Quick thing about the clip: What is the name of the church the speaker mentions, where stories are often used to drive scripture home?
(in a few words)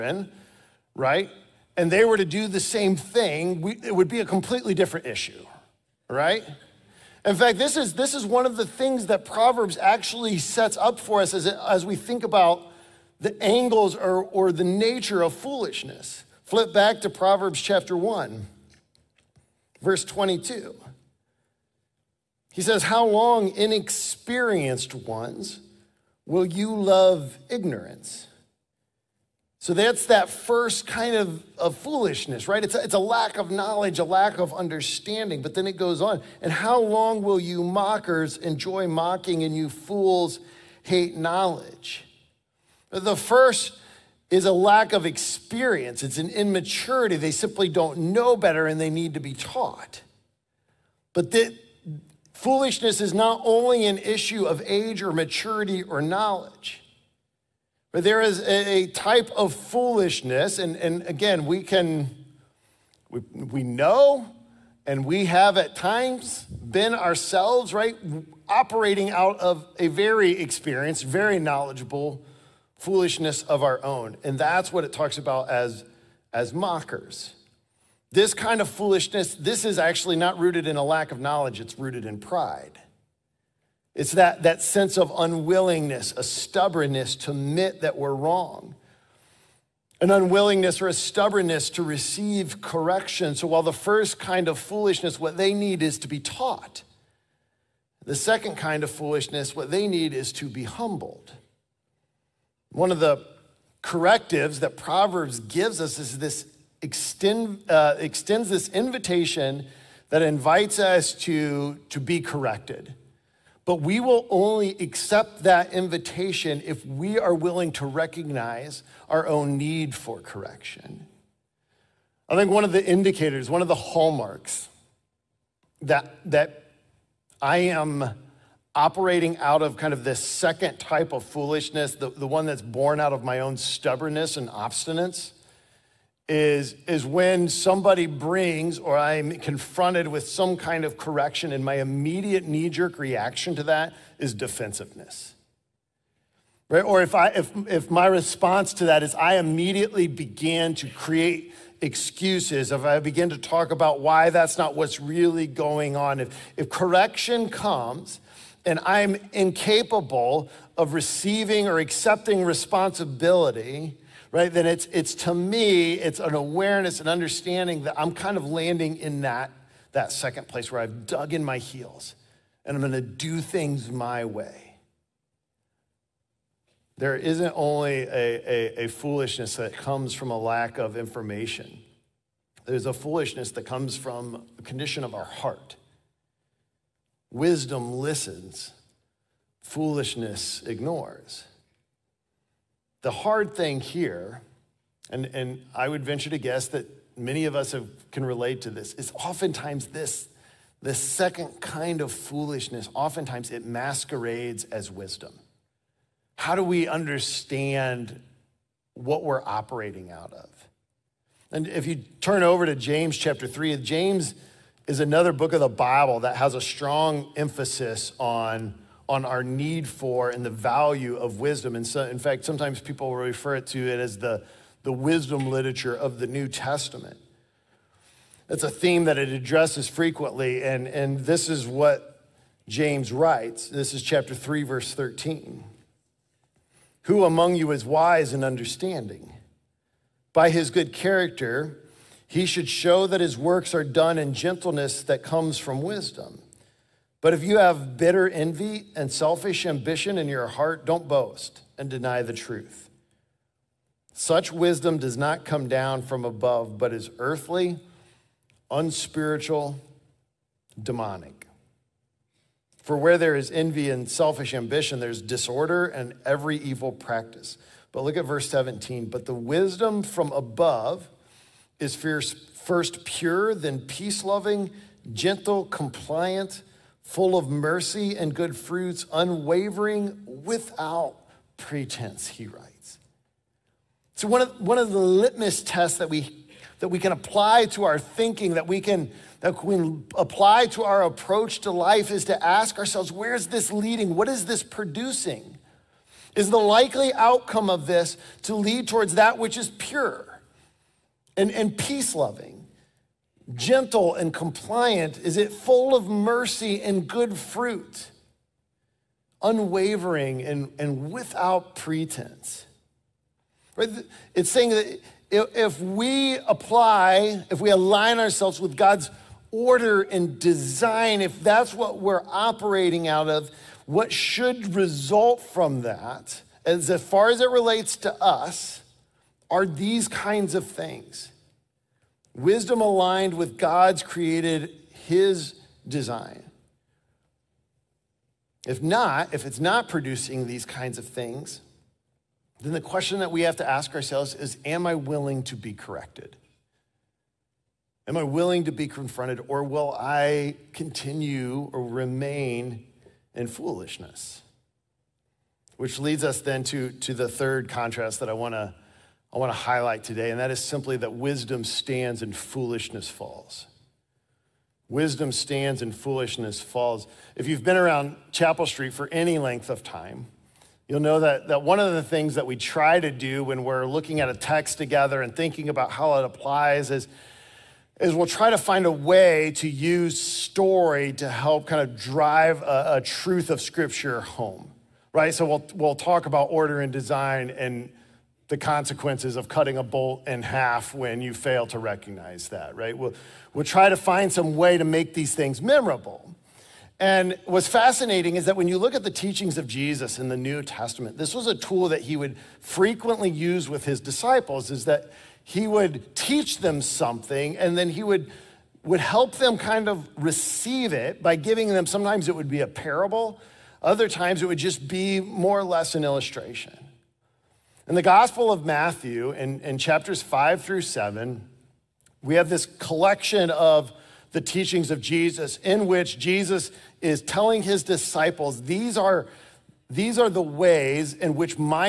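Chapel Street.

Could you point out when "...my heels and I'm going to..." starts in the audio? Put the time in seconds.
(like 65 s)
171 s.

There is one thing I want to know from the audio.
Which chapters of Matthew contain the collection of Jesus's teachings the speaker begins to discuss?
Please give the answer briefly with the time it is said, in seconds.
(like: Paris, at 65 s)
Chapters 5 through 7, at 419 s.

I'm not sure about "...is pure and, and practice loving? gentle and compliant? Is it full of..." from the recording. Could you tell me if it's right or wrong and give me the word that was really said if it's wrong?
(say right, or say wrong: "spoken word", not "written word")
wrong: "peace", not "practice".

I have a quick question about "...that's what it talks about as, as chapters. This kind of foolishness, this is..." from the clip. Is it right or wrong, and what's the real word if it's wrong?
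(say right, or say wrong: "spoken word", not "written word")
wrong: "mockers", not "chapters".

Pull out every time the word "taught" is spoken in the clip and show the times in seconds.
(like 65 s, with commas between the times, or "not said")
49 s, 96 s.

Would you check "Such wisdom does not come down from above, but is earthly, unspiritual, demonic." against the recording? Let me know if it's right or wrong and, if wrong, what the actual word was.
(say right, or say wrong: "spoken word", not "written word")
right.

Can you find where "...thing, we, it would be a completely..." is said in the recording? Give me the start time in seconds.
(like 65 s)
2 s.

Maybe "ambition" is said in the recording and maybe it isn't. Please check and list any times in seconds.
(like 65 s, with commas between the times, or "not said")
249 s, 264 s.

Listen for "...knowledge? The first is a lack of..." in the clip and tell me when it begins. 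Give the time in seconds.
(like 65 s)
41 s.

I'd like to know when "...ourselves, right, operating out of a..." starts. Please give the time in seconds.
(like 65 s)
66 s.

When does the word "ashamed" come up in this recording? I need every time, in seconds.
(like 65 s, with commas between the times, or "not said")
not said.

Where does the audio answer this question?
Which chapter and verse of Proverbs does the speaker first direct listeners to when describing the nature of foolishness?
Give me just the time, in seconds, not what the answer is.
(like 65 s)
17 s.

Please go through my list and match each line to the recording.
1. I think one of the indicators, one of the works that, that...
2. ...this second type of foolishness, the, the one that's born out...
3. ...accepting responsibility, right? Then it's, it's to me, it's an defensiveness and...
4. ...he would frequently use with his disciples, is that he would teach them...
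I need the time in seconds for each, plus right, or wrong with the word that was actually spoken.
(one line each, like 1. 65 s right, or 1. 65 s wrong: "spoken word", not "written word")
1. 122 s wrong: "hallmarks", not "works"
2. 130 s right
3. 161 s wrong: "awareness", not "defensiveness"
4. 402 s right.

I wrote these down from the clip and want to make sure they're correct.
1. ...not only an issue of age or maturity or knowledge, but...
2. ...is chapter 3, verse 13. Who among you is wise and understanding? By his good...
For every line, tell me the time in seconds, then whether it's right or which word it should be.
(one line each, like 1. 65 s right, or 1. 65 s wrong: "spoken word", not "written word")
1. 53 s right
2. 233 s right.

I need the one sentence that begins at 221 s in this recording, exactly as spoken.
And so, in fact, sometimes people refer to it as the, the wisdom literature of the New Testament.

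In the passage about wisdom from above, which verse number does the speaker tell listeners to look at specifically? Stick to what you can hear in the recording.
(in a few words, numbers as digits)
Verse 17.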